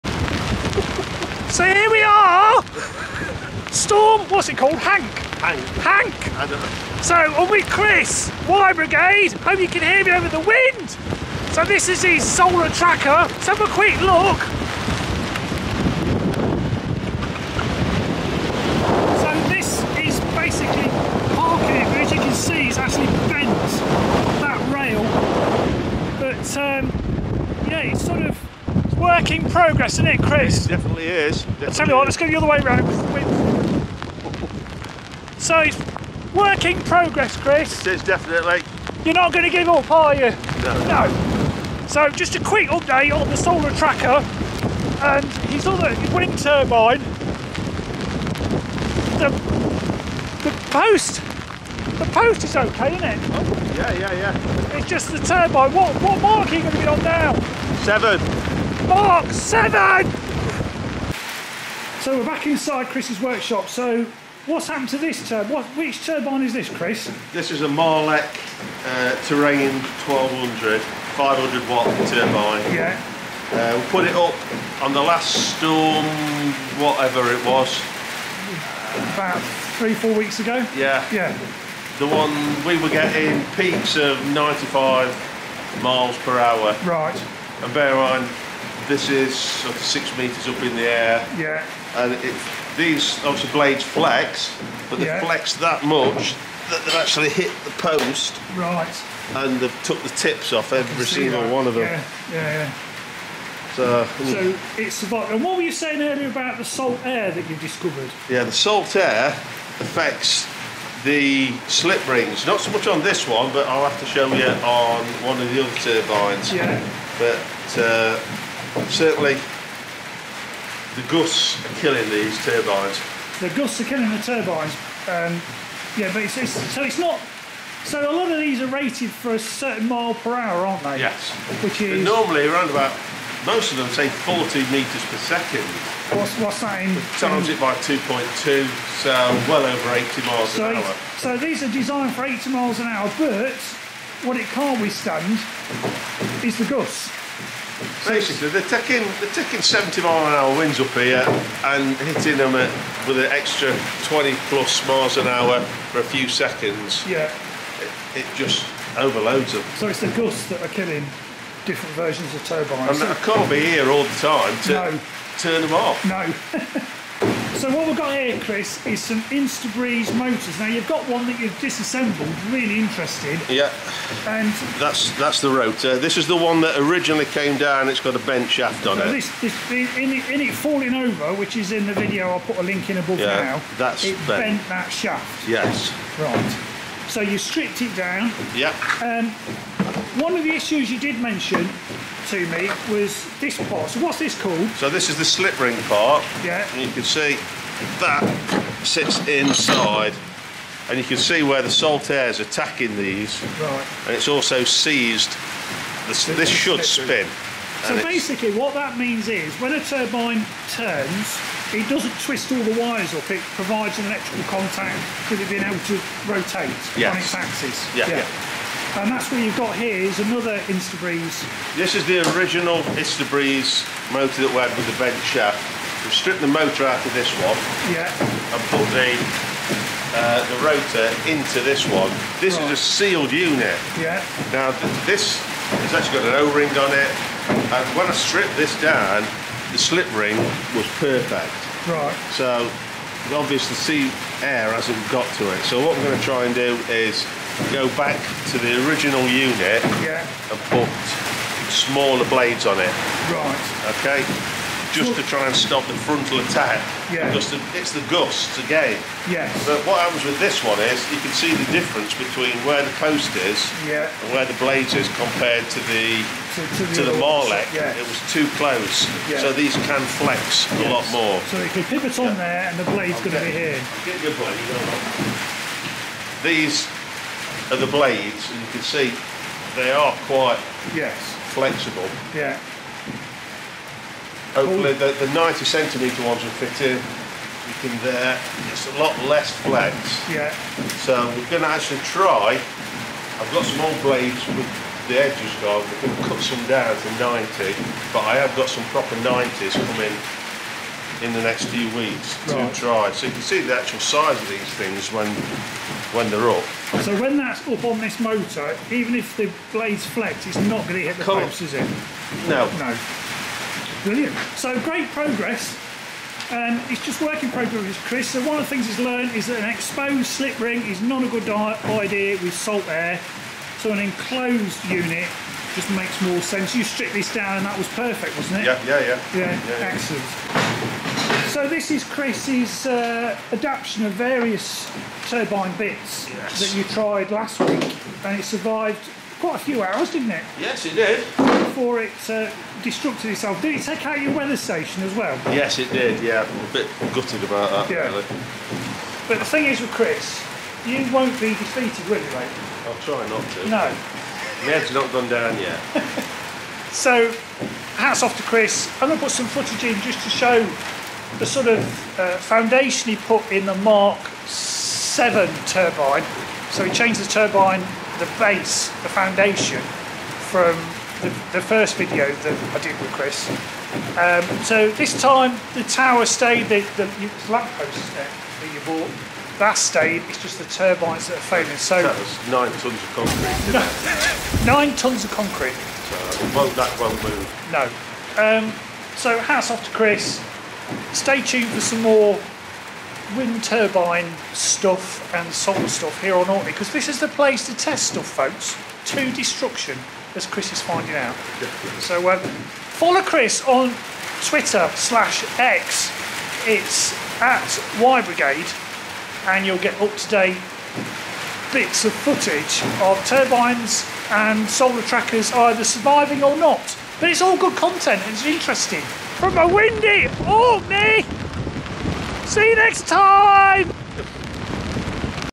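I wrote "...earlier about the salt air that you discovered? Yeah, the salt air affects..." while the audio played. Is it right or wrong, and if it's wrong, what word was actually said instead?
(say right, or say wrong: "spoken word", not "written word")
right.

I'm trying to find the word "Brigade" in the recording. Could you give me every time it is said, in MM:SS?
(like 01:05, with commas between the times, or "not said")
00:08, 06:48.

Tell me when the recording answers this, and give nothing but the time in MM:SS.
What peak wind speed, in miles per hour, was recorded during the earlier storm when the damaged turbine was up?
01:24.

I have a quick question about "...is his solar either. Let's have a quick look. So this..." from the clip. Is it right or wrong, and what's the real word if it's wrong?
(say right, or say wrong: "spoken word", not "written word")
wrong: "tracker", not "either".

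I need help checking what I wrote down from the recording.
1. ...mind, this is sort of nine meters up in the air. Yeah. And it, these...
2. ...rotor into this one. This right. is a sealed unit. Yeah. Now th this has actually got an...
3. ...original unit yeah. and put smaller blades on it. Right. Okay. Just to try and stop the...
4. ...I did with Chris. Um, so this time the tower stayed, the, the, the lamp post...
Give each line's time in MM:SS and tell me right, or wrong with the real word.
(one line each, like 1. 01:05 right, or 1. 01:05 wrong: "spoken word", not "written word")
1. 01:27 wrong: "six", not "nine"
2. 03:50 right
3. 04:08 right
4. 06:12 right.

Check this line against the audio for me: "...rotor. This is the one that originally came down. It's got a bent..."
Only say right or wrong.
right.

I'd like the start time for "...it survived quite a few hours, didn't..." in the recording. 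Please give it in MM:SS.
05:38.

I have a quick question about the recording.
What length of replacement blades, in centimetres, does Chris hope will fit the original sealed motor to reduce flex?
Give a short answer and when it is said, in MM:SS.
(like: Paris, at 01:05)
90, at 04:45.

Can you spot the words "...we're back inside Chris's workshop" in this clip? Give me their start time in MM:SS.
01:02.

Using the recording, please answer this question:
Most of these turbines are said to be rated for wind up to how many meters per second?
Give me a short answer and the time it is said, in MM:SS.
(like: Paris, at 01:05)
40, at 02:14.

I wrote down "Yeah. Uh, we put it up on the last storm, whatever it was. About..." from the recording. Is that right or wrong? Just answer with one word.
right.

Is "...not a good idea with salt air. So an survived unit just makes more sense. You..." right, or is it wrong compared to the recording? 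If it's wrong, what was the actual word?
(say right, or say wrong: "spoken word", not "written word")
wrong: "enclosed", not "survived".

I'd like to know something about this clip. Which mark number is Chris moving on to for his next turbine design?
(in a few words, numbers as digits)
7.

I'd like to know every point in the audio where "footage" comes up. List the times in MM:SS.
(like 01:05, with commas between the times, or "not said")
05:59, 06:52.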